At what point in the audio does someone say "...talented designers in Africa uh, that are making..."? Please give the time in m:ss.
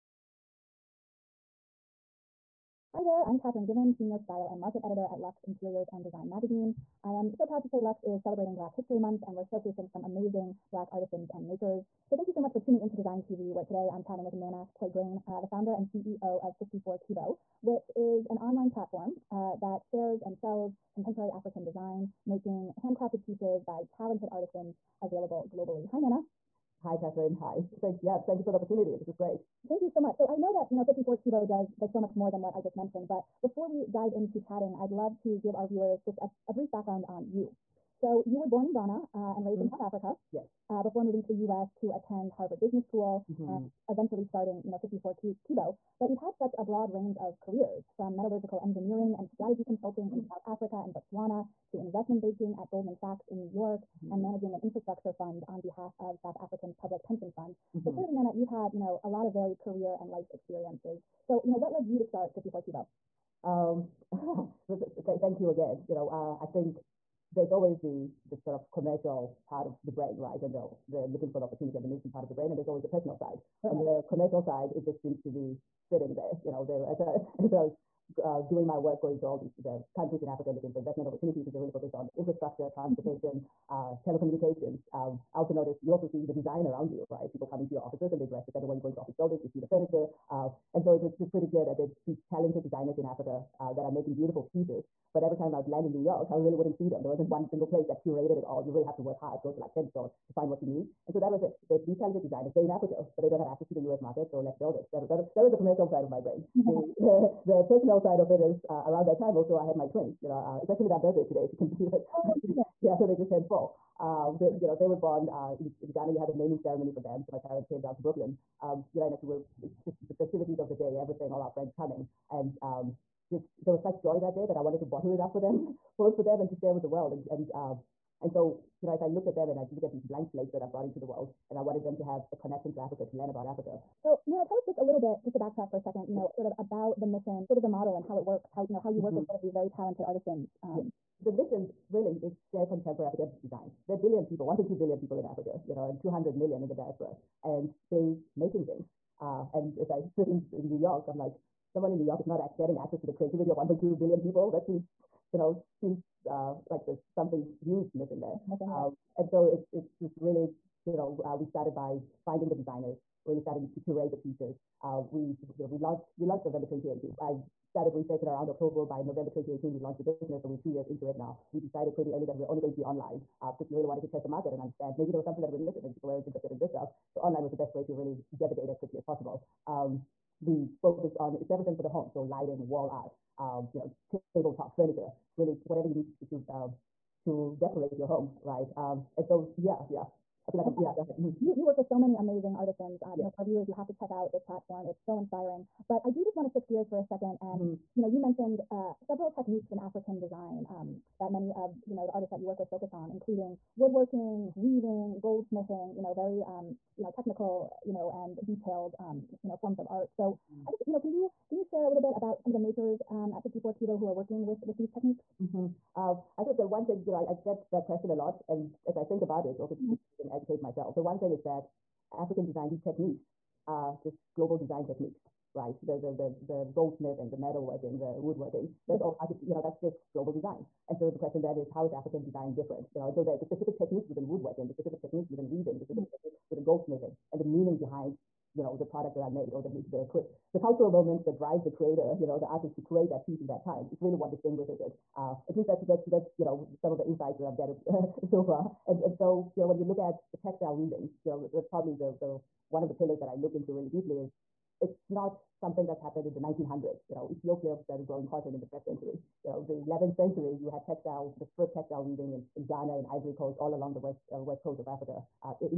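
1:32.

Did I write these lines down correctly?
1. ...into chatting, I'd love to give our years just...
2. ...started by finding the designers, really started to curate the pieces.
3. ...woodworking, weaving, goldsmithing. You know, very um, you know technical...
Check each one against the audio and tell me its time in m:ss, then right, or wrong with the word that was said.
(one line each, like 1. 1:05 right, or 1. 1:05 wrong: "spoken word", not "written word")
1. 0:34 wrong: "viewers", not "years"
2. 2:41 right
3. 3:23 right.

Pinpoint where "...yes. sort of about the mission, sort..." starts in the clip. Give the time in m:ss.
2:16.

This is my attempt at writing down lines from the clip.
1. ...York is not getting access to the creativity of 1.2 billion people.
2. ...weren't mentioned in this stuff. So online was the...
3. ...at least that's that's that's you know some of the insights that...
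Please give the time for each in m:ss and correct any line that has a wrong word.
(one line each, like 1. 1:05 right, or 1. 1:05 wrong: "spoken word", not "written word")
1. 2:32 right
2. 2:56 wrong: "interested", not "mentioned"
3. 4:05 right.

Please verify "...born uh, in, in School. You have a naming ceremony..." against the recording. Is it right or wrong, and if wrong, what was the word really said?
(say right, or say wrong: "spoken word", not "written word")
wrong: "Ghana", not "School".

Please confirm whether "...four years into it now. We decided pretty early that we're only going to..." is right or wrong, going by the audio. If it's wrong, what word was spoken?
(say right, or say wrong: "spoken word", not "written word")
wrong: "two", not "four".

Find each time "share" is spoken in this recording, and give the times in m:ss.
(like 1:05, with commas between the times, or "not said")
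0:19, 2:06, 2:22, 3:31.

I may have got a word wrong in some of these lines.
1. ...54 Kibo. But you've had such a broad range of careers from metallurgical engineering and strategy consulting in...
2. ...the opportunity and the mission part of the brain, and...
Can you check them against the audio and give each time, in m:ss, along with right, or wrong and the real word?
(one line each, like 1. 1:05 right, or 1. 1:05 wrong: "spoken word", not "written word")
1. 0:44 right
2. 1:11 right.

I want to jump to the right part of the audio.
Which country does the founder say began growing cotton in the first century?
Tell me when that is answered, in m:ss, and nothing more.
4:17.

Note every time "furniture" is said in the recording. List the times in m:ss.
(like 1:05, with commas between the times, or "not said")
1:29, 3:04.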